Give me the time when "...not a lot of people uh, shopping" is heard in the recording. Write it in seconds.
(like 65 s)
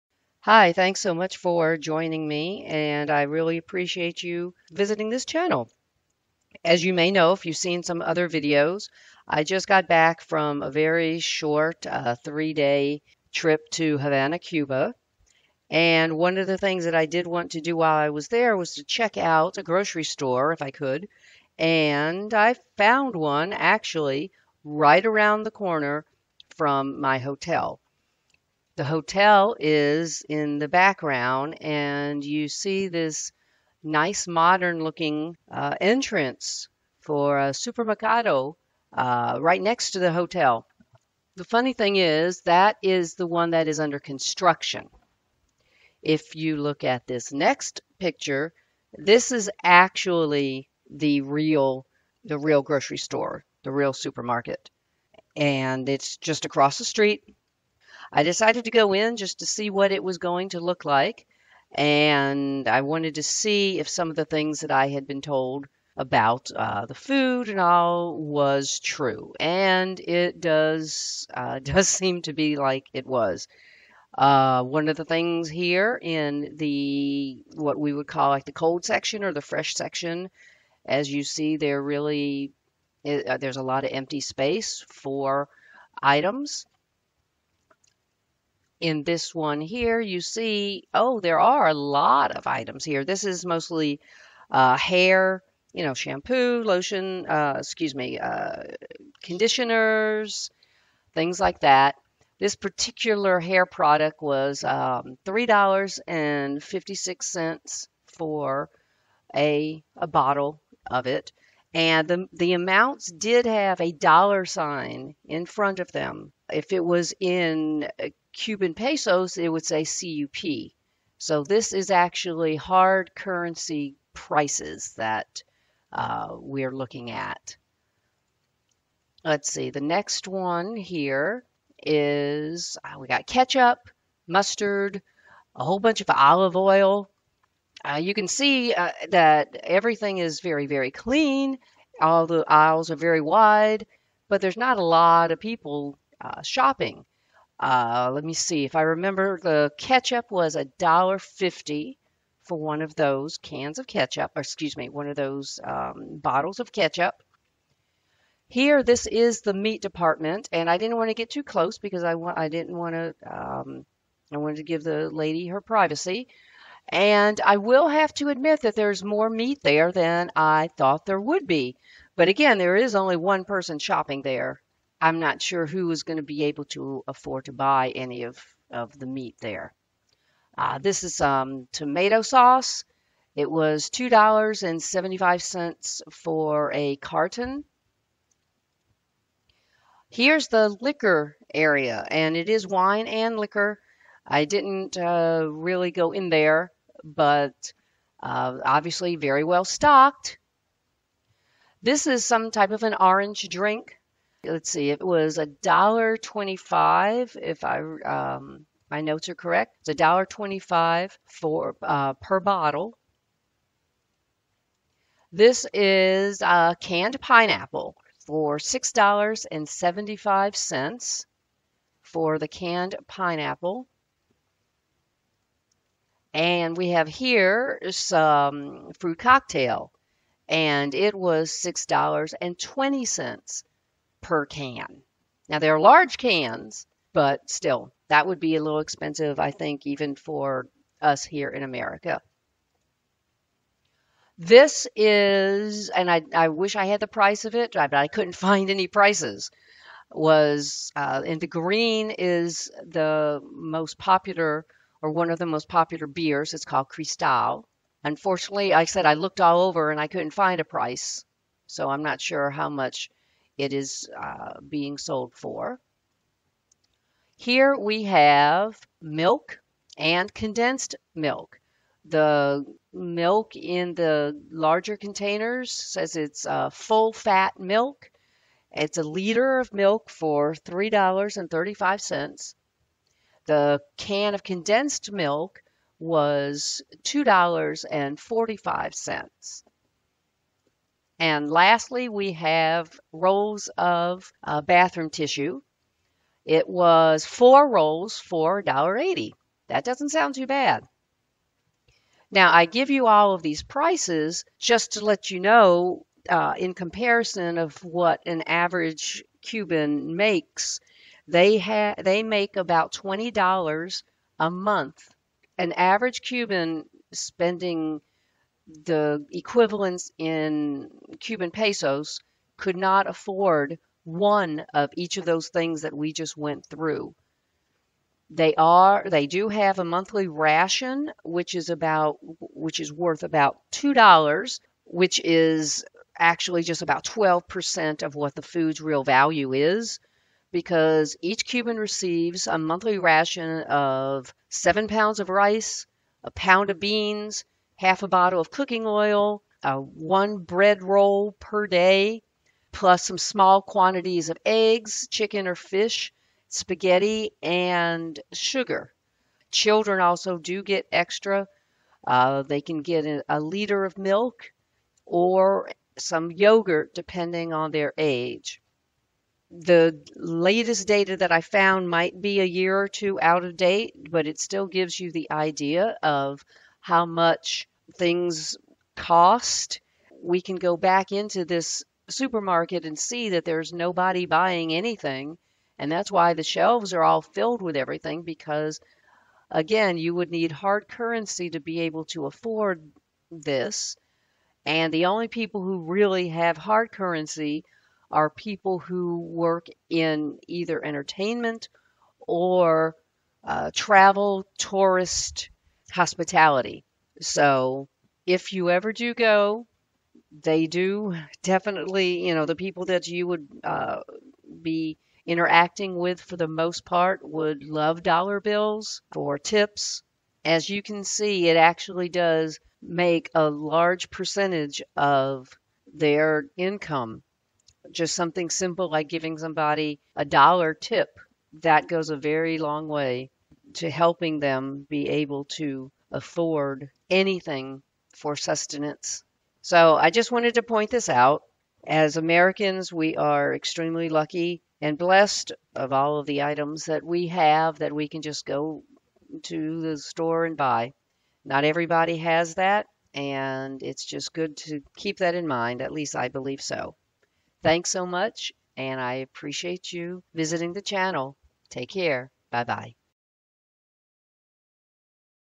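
144 s.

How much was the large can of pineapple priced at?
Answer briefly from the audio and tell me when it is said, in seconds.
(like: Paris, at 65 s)
$6.75, at 218 s.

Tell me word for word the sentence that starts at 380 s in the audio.
We can go back into this supermarket and see that there's nobody buying anything.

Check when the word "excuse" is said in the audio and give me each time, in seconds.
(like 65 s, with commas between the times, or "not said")
97 s, 154 s.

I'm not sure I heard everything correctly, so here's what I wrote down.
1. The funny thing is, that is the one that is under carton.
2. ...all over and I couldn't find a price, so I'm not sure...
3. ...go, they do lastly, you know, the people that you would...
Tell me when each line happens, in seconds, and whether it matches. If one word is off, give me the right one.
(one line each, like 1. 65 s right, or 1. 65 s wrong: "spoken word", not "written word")
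1. 41 s wrong: "construction", not "carton"
2. 259 s right
3. 409 s wrong: "definitely", not "lastly".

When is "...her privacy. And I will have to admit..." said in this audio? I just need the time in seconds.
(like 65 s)
165 s.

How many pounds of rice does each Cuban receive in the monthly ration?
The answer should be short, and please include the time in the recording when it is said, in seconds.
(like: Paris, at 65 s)
7, at 344 s.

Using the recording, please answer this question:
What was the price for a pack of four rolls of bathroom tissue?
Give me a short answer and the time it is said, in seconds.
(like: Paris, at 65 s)
$1.80, at 298 s.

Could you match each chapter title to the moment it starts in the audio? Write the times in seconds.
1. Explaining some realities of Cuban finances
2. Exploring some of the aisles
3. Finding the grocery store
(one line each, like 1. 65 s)
1. 302 s
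2. 73 s
3. 26 s.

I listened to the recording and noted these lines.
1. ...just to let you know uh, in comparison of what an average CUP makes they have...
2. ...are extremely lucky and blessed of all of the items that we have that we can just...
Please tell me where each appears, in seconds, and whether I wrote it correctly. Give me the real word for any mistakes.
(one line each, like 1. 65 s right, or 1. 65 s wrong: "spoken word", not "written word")
1. 304 s wrong: "Cuban", not "CUP"
2. 443 s right.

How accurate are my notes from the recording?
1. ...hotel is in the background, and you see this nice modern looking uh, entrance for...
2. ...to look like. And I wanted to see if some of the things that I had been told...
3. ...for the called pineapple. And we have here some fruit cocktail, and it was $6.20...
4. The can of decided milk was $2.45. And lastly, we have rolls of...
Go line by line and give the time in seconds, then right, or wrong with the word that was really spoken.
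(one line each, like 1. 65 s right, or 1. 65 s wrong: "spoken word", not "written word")
1. 28 s right
2. 60 s right
3. 222 s wrong: "canned", not "called"
4. 283 s wrong: "condensed", not "decided".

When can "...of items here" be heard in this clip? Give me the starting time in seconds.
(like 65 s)
92 s.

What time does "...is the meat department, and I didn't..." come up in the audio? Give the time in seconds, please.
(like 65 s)
159 s.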